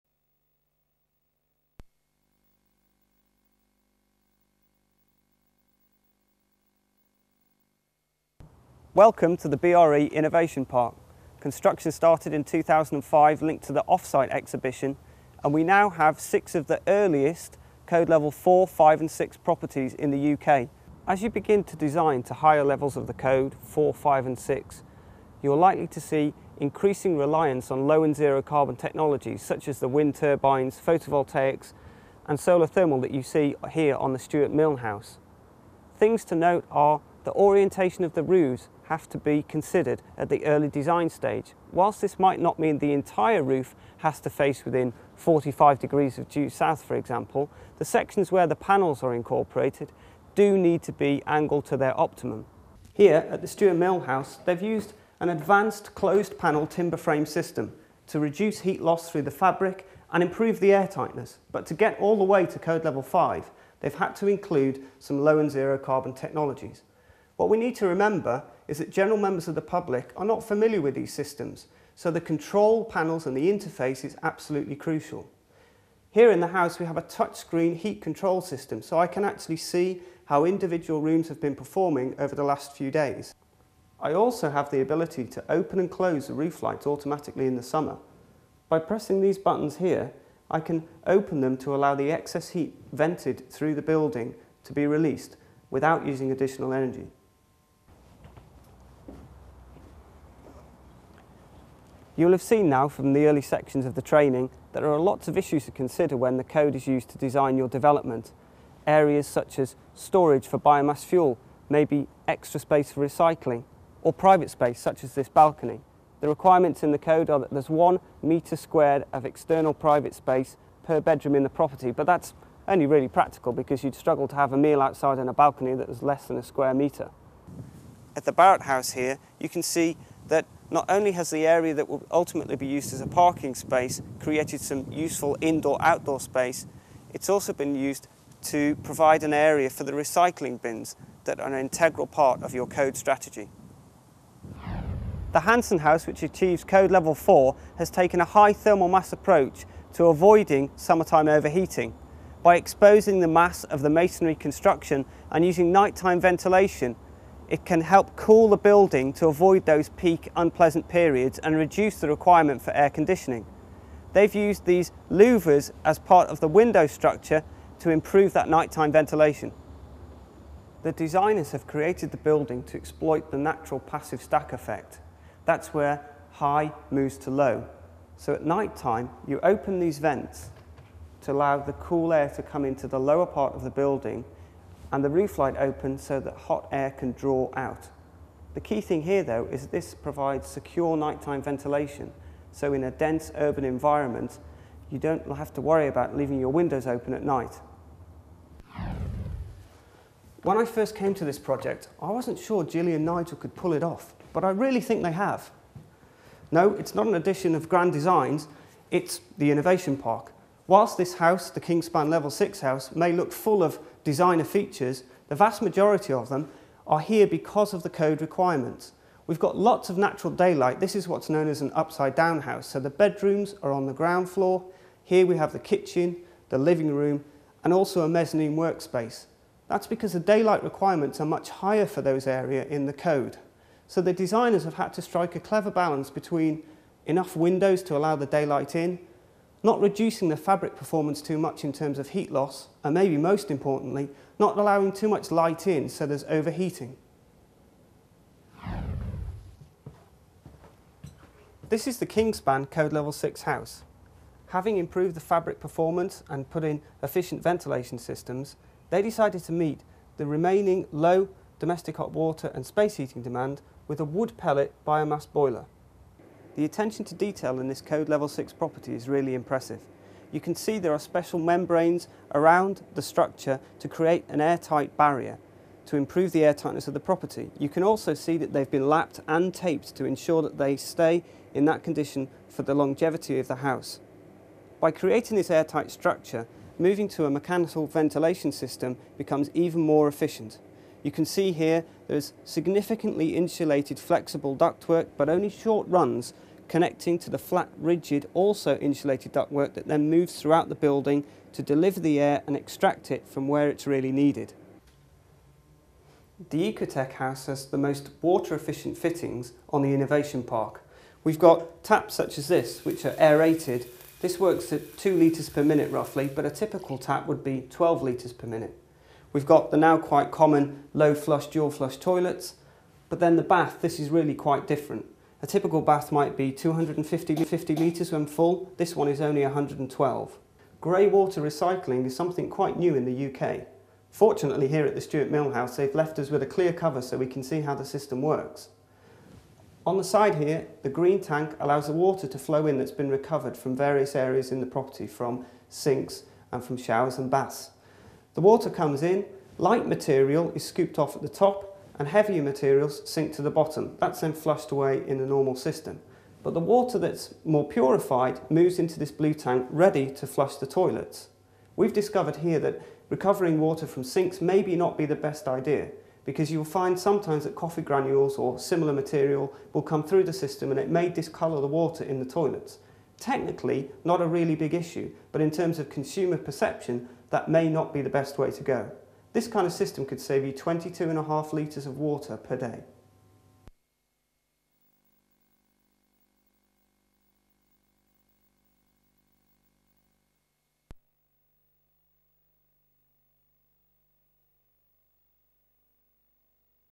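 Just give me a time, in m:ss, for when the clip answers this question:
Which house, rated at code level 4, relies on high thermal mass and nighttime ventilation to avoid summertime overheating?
2:25.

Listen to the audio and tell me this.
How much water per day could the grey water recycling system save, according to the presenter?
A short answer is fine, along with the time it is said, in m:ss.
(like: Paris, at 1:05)
22.5 litres, at 6:20.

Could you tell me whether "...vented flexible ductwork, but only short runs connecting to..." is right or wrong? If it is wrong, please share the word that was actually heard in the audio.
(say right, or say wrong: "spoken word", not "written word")
wrong: "insulated", not "vented".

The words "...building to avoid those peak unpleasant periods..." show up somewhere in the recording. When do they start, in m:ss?
2:38.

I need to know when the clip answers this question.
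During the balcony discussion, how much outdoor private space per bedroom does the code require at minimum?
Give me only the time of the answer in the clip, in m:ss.
1:57.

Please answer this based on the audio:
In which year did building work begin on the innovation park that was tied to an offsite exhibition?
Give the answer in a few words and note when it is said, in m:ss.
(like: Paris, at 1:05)
2005, at 0:12.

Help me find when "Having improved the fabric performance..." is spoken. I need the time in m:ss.
4:14.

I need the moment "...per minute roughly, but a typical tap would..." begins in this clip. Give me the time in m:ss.
5:15.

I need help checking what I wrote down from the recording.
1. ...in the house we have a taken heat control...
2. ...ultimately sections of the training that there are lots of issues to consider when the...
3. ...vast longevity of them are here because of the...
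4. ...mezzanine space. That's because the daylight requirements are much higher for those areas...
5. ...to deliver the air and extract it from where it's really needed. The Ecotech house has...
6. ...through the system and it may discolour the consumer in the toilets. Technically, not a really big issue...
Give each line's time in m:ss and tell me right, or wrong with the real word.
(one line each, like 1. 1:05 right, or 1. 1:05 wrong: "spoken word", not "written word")
1. 1:16 wrong: "touchscreen", not "taken"
2. 1:43 wrong: "early", not "ultimately"
3. 3:35 wrong: "majority", not "longevity"
4. 3:48 wrong: "workspace", not "space"
5. 5:01 right
6. 6:10 wrong: "water", not "consumer".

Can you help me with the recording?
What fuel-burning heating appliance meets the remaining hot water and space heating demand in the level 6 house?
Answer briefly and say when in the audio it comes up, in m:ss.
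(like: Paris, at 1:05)
Wood pellet biomass boiler, at 4:24.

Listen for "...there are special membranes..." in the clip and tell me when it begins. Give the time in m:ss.
4:30.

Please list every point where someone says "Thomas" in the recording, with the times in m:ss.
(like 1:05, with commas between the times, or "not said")
not said.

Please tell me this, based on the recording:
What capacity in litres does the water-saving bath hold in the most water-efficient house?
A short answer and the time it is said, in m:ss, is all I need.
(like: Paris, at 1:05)
112, at 5:29.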